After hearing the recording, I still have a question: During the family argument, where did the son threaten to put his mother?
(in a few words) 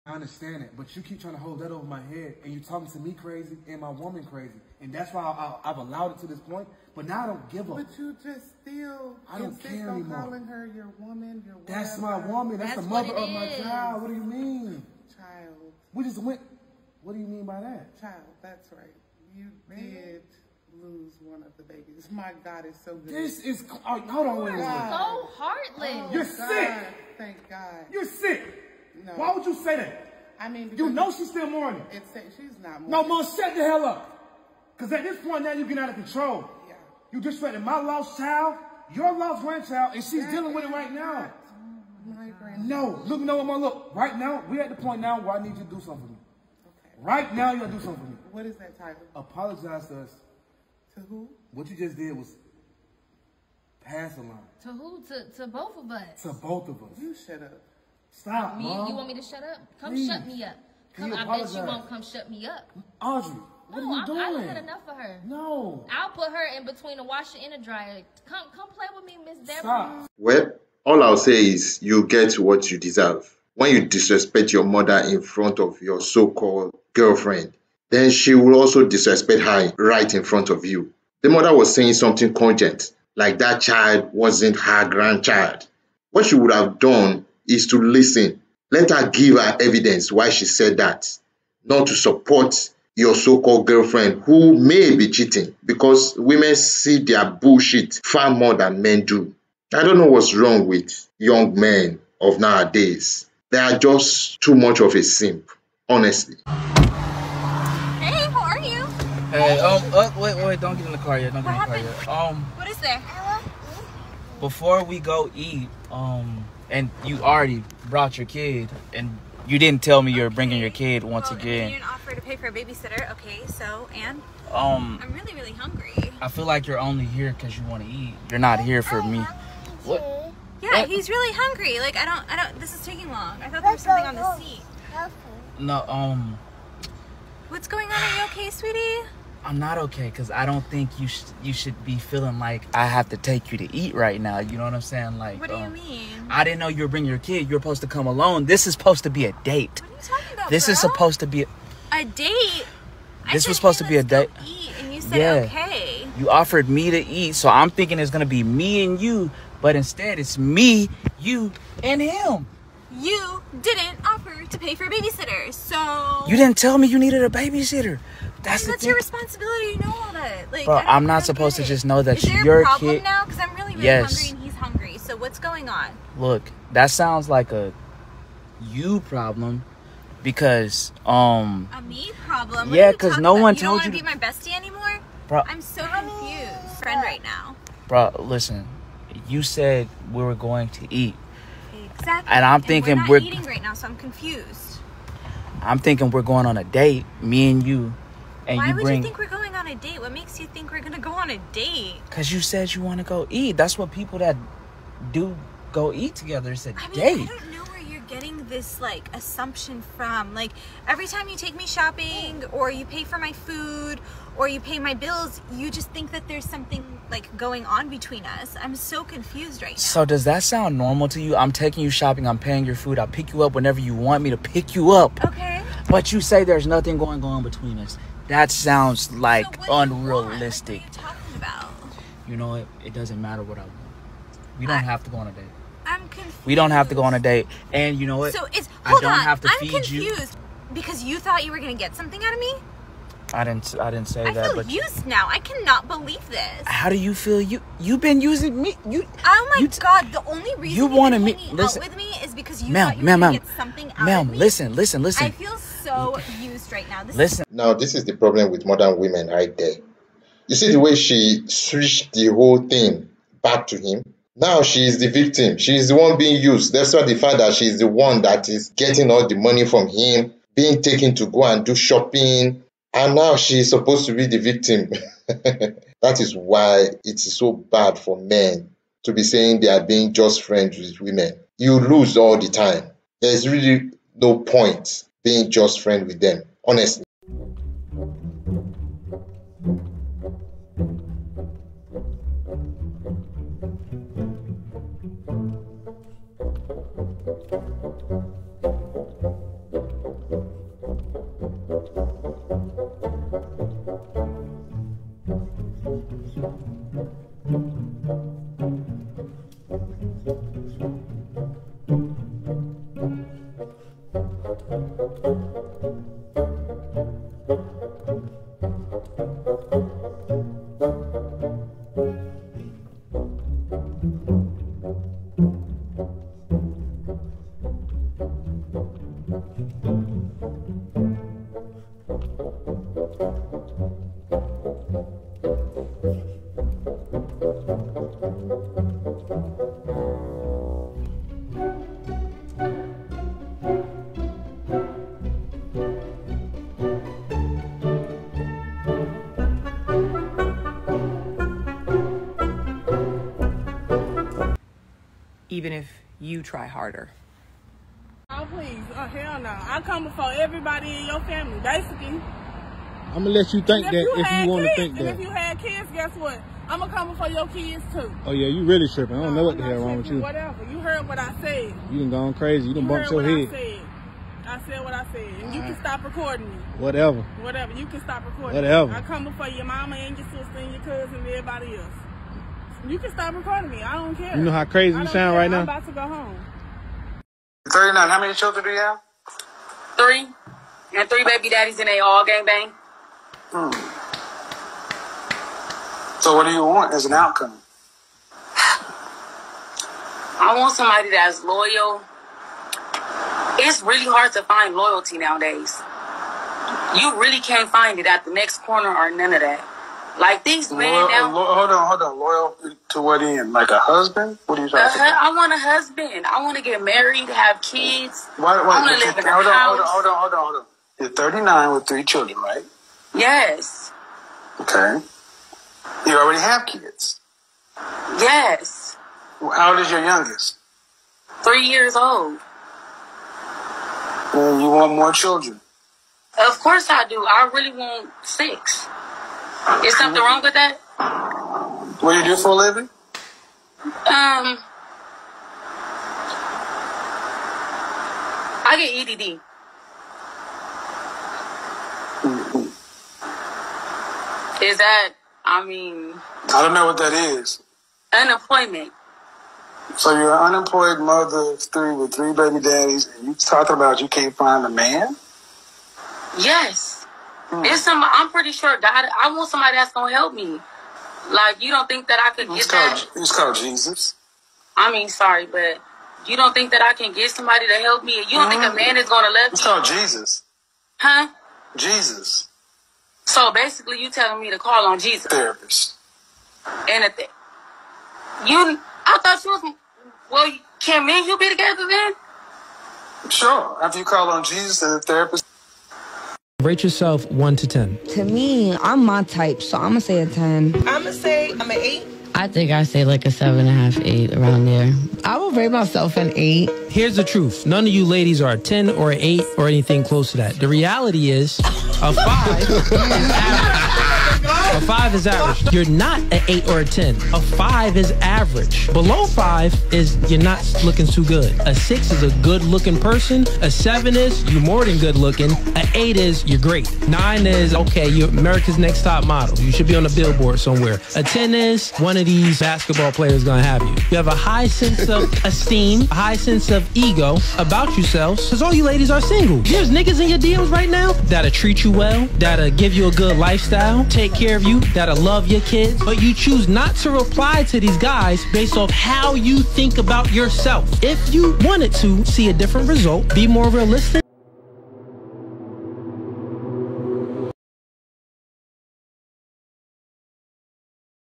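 Between a washer and a dryer.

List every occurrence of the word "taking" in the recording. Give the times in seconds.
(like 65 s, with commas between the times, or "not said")
132 s, 221 s.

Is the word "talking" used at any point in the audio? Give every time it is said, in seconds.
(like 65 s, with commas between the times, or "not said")
2 s, 150 s, 414 s, 463 s.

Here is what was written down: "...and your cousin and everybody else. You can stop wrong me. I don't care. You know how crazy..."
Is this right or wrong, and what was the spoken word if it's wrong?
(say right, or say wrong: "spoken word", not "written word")
wrong: "recording", not "wrong".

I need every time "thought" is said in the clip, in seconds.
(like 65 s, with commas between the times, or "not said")
133 s, 241 s, 252 s, 489 s.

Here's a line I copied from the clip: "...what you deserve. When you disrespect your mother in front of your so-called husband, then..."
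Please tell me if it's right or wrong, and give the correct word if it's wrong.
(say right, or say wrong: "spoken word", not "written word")
wrong: "girlfriend", not "husband".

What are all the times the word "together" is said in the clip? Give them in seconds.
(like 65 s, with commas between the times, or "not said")
206 s, 491 s.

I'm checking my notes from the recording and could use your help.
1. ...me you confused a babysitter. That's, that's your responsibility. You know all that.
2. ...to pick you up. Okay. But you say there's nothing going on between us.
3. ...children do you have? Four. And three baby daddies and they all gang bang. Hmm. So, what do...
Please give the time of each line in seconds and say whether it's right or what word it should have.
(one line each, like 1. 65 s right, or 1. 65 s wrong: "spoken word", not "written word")
1. 166 s wrong: "needed", not "confused"
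2. 224 s right
3. 388 s wrong: "Three", not "Four".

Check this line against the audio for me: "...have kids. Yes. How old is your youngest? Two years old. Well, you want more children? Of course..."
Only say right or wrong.
wrong.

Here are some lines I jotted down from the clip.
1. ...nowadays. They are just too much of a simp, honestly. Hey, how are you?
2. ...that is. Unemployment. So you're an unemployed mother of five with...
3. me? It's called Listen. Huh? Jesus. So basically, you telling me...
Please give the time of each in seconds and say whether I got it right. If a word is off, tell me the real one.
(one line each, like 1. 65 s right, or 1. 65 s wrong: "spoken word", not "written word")
1. 102 s right
2. 456 s wrong: "three", not "five"
3. 479 s wrong: "Jesus", not "Listen".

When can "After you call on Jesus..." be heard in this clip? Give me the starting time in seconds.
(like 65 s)
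493 s.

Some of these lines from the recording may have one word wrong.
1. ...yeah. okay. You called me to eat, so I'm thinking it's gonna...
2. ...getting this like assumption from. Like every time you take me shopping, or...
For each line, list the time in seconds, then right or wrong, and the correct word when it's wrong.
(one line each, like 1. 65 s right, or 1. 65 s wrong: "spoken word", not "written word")
1. 155 s wrong: "offered", not "called"
2. 208 s right.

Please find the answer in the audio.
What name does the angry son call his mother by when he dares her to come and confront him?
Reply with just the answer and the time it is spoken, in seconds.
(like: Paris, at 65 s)
Miss Deborah, at 69 s.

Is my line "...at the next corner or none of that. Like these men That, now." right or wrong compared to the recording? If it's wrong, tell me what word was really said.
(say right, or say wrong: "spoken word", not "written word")
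wrong: "Loyal", not "That".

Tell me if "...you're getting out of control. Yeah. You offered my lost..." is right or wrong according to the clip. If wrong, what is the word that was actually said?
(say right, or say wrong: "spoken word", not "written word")
wrong: "disrespected", not "offered".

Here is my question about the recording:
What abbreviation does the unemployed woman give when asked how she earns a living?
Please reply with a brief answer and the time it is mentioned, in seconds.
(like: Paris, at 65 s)
EDD, at 449 s.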